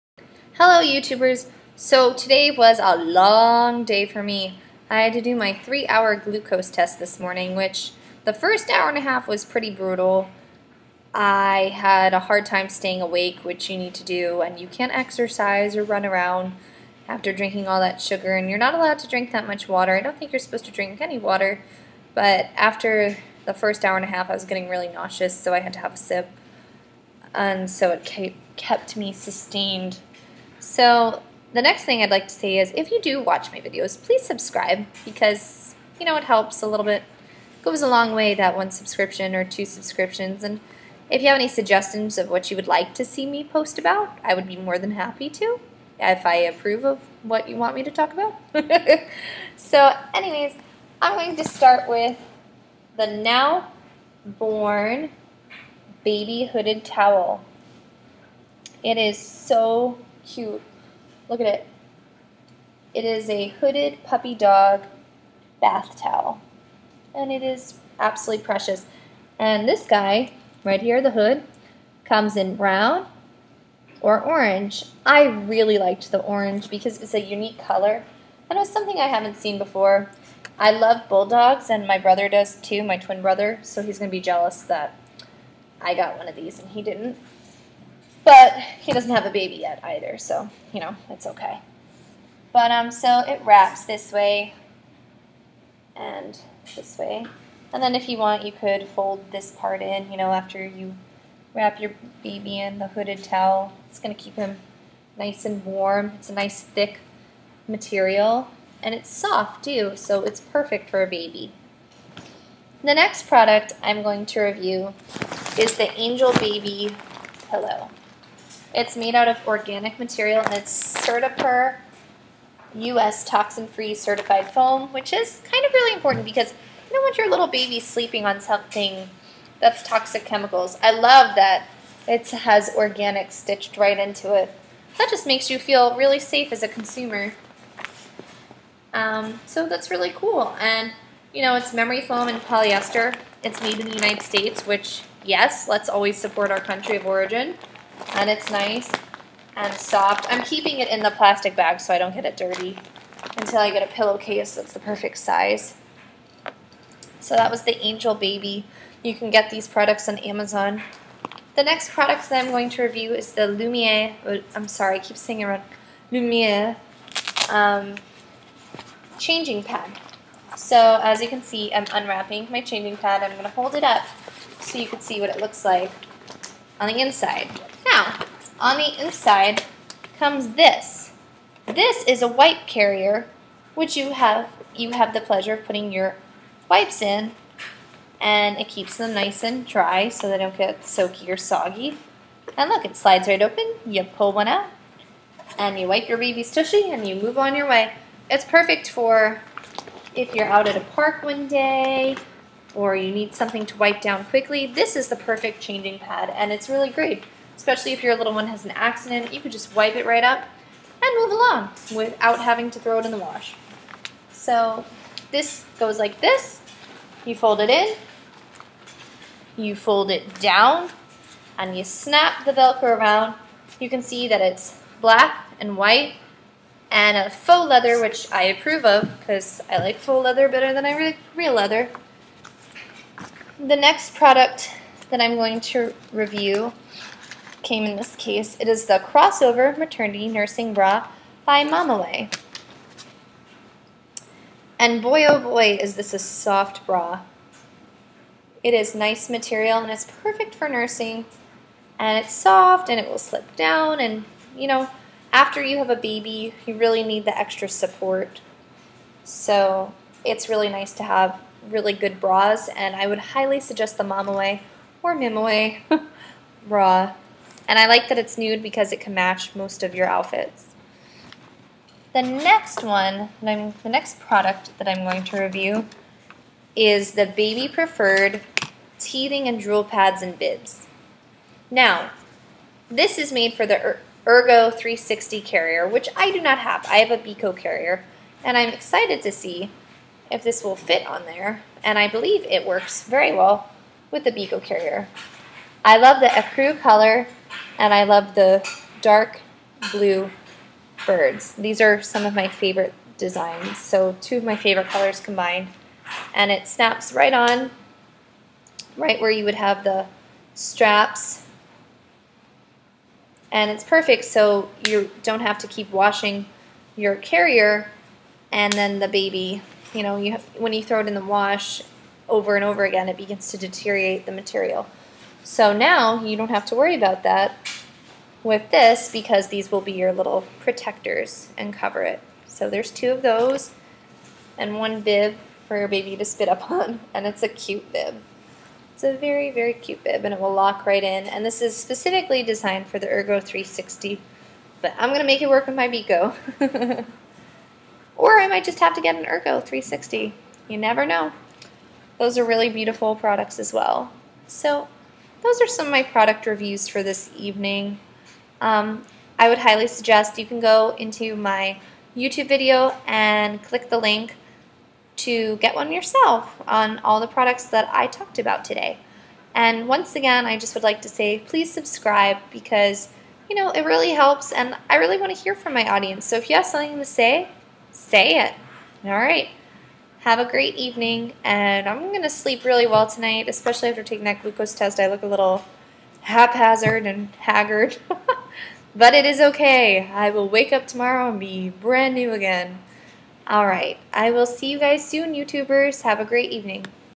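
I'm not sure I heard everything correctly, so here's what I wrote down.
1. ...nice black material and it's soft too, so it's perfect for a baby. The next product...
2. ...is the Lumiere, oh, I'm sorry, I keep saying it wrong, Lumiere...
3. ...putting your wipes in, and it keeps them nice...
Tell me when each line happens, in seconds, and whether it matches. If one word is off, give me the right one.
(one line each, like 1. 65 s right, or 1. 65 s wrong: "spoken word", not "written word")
1. 106 s wrong: "thick", not "black"
2. 163 s right
3. 185 s right.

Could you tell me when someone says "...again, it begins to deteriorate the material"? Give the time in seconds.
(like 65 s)
322 s.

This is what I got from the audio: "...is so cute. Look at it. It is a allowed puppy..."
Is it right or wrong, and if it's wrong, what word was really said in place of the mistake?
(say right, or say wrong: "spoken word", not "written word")
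wrong: "hooded", not "allowed".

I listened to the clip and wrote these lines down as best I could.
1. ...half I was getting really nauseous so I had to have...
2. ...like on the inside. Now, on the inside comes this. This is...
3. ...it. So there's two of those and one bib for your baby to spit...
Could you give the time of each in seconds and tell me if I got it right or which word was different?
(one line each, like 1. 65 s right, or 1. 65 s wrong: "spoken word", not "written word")
1. 24 s right
2. 175 s right
3. 332 s right.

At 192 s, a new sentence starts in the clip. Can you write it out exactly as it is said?
And look, it slides right open.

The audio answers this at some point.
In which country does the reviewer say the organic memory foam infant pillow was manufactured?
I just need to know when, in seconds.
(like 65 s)
143 s.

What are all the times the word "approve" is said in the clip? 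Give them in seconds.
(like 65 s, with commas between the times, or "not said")
46 s, 228 s.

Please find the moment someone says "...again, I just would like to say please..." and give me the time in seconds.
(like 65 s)
370 s.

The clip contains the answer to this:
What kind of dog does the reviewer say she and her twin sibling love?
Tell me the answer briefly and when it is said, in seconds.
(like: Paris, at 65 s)
bulldogs, at 81 s.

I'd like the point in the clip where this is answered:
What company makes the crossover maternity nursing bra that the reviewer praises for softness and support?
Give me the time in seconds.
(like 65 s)
241 s.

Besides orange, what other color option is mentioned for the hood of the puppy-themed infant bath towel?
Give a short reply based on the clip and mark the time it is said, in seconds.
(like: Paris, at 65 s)
brown, at 72 s.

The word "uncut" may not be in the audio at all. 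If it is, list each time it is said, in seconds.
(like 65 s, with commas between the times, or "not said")
not said.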